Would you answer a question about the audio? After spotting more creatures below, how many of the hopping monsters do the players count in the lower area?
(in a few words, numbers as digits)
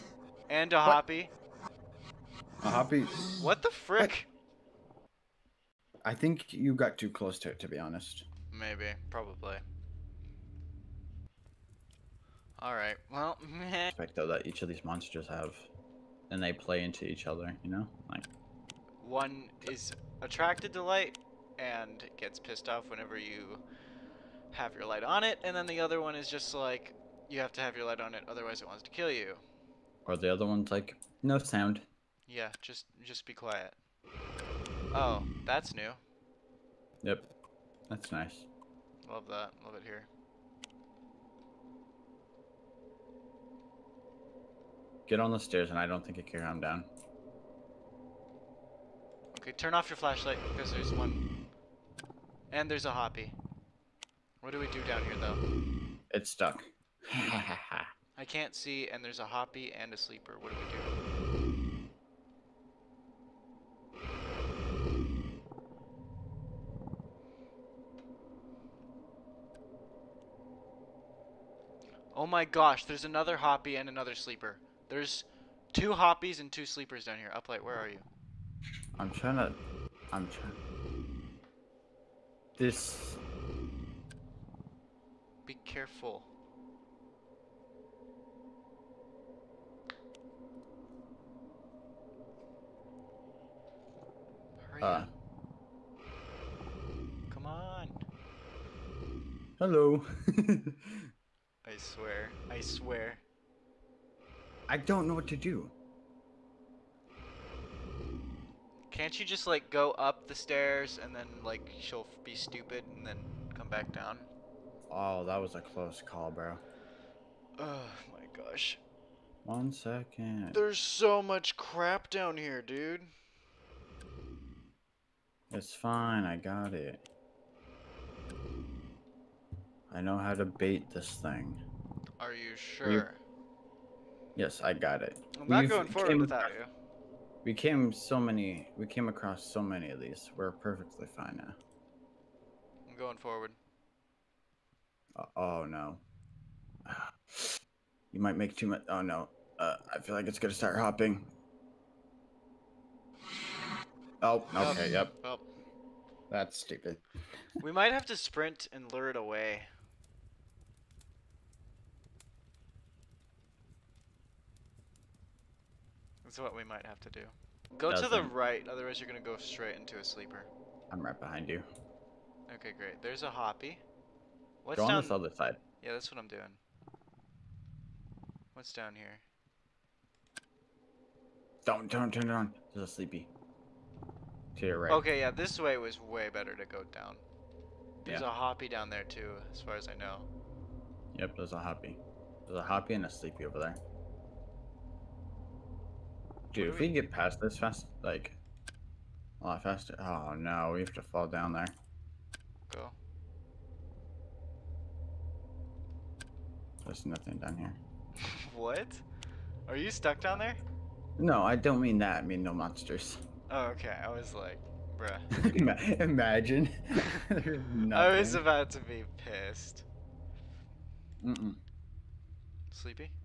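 2.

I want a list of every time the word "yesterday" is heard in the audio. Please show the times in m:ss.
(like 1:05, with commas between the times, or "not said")
not said.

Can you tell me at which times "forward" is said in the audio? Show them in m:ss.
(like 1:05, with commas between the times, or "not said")
2:15, 2:23.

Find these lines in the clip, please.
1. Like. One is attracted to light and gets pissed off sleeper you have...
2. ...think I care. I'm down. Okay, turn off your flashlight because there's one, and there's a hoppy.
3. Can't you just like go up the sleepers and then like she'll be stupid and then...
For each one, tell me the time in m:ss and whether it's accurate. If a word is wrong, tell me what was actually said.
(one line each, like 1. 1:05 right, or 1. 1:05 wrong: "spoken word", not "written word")
1. 0:18 wrong: "whenever", not "sleeper"
2. 0:46 right
3. 1:48 wrong: "stairs", not "sleepers".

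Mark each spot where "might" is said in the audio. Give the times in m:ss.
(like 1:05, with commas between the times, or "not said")
2:28, 2:37, 2:46.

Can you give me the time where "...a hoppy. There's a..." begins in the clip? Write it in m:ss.
3:11.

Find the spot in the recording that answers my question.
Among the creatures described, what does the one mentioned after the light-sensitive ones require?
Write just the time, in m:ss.
0:31.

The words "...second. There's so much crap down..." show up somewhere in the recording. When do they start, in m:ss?
1:59.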